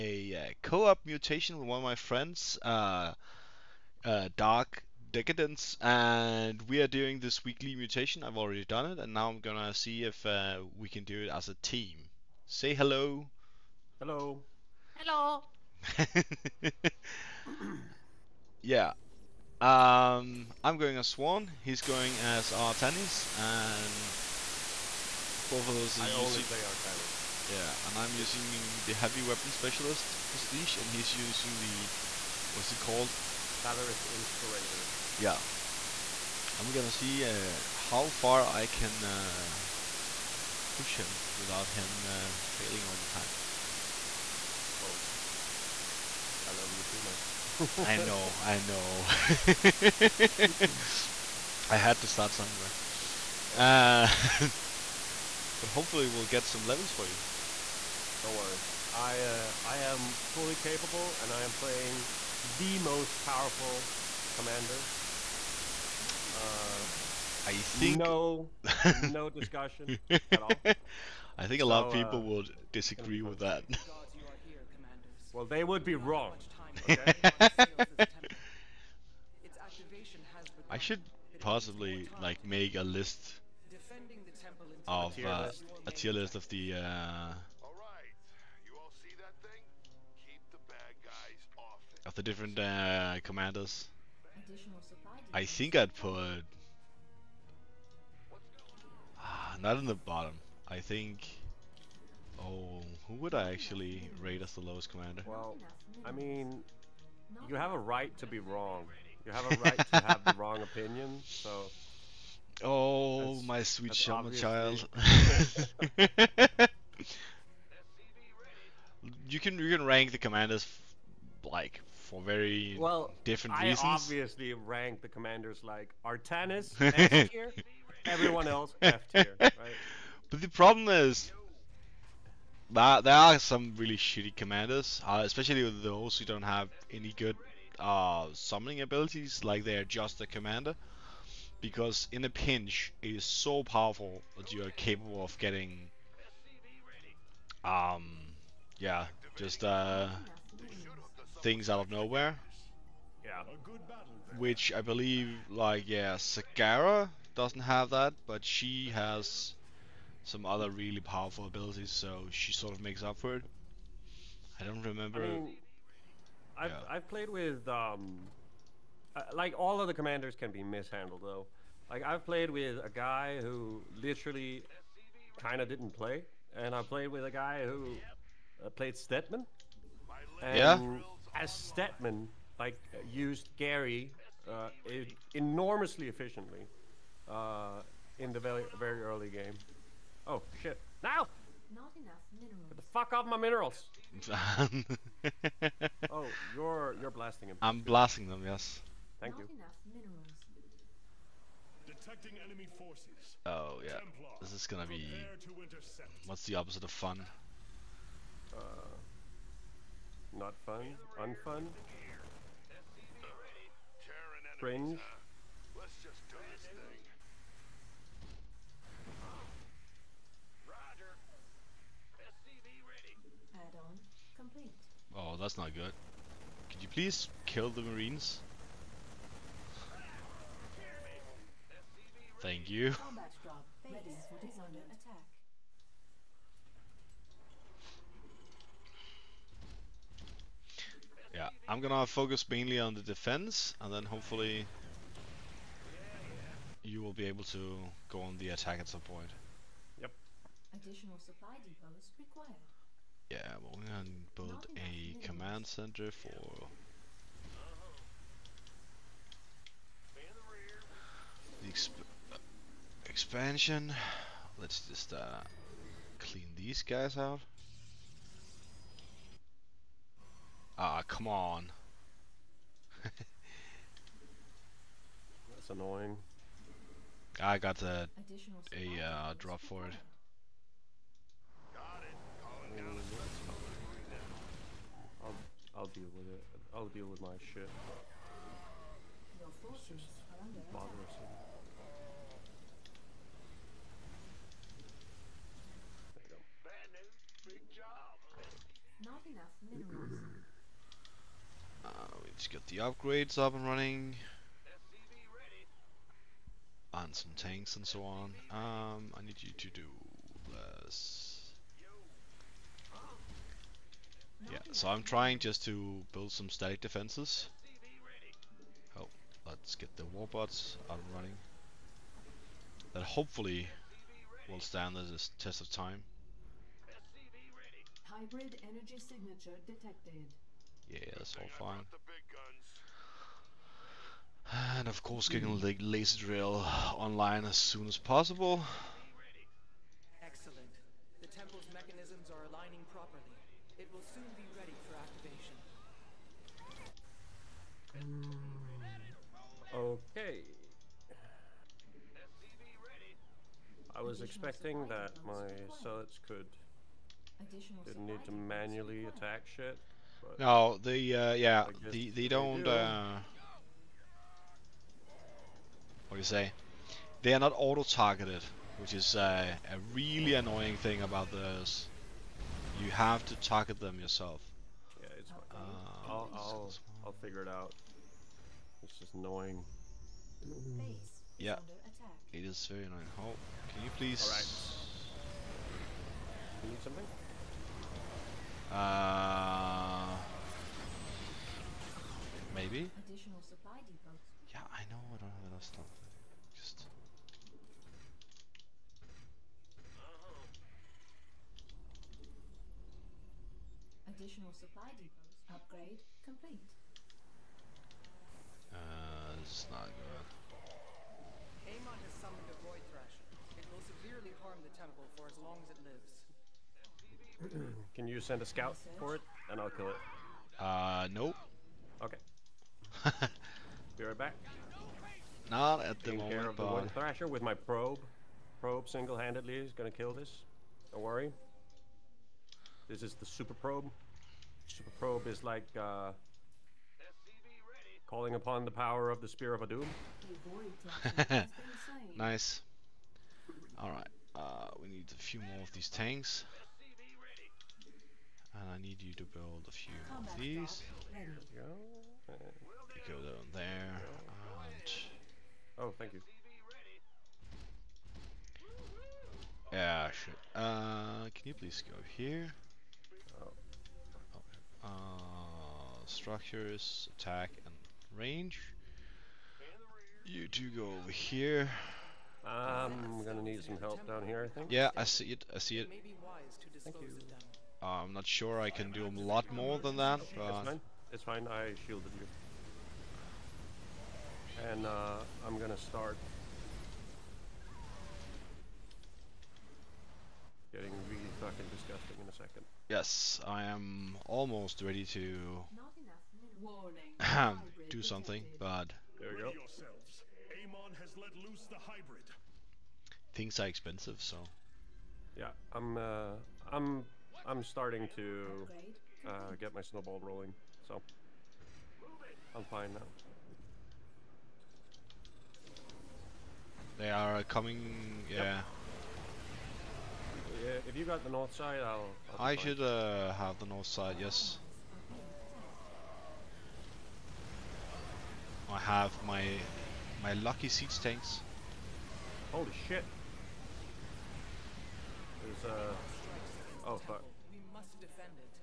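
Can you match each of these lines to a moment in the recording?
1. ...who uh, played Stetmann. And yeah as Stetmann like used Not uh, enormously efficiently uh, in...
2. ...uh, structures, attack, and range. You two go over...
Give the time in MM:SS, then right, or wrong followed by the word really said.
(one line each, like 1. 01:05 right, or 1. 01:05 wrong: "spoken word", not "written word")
1. 02:57 wrong: "Gary", not "Not"
2. 07:44 right.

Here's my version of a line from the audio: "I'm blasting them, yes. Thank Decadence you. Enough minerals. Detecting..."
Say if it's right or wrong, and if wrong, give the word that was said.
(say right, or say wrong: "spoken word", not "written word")
wrong: "Not", not "Decadence".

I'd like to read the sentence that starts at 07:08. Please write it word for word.
Probe single-handedly is gonna kill this.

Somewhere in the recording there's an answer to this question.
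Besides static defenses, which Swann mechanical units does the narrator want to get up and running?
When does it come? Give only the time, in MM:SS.
05:20.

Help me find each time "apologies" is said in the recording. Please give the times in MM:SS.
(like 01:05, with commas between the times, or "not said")
not said.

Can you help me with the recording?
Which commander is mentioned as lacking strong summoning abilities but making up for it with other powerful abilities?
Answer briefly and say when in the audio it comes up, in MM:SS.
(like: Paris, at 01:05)
Zagara, at 02:36.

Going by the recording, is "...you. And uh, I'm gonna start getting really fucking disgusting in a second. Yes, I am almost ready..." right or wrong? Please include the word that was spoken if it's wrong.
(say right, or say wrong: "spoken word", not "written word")
right.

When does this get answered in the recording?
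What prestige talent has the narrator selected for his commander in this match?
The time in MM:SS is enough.
00:28.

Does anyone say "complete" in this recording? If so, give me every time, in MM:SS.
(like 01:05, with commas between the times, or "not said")
03:44, 06:46.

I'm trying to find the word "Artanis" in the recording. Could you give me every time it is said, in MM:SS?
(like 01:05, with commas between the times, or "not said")
00:22, 00:26, 02:06.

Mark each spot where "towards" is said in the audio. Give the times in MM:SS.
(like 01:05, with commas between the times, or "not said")
not said.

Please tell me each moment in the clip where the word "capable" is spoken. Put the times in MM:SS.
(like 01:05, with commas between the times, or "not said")
01:00, 02:24.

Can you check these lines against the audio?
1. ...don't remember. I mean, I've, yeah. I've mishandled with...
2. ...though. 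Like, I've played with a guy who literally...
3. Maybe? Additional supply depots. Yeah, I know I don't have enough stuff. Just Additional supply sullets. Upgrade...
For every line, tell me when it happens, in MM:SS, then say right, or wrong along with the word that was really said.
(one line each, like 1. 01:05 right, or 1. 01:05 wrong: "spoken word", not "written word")
1. 02:44 wrong: "played", not "mishandled"
2. 02:51 right
3. 06:32 wrong: "depots", not "sullets".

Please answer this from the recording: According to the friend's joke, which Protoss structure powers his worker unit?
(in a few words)
Spear of Adun.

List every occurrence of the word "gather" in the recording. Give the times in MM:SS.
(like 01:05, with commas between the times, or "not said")
not said.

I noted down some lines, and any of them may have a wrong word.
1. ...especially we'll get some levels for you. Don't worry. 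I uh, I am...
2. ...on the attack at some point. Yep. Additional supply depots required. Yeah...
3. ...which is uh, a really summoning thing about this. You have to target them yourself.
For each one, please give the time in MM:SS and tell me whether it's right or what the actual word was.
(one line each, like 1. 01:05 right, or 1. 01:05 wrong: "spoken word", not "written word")
1. 00:55 wrong: "hopefully", not "especially"
2. 04:08 right
3. 06:08 wrong: "annoying", not "summoning".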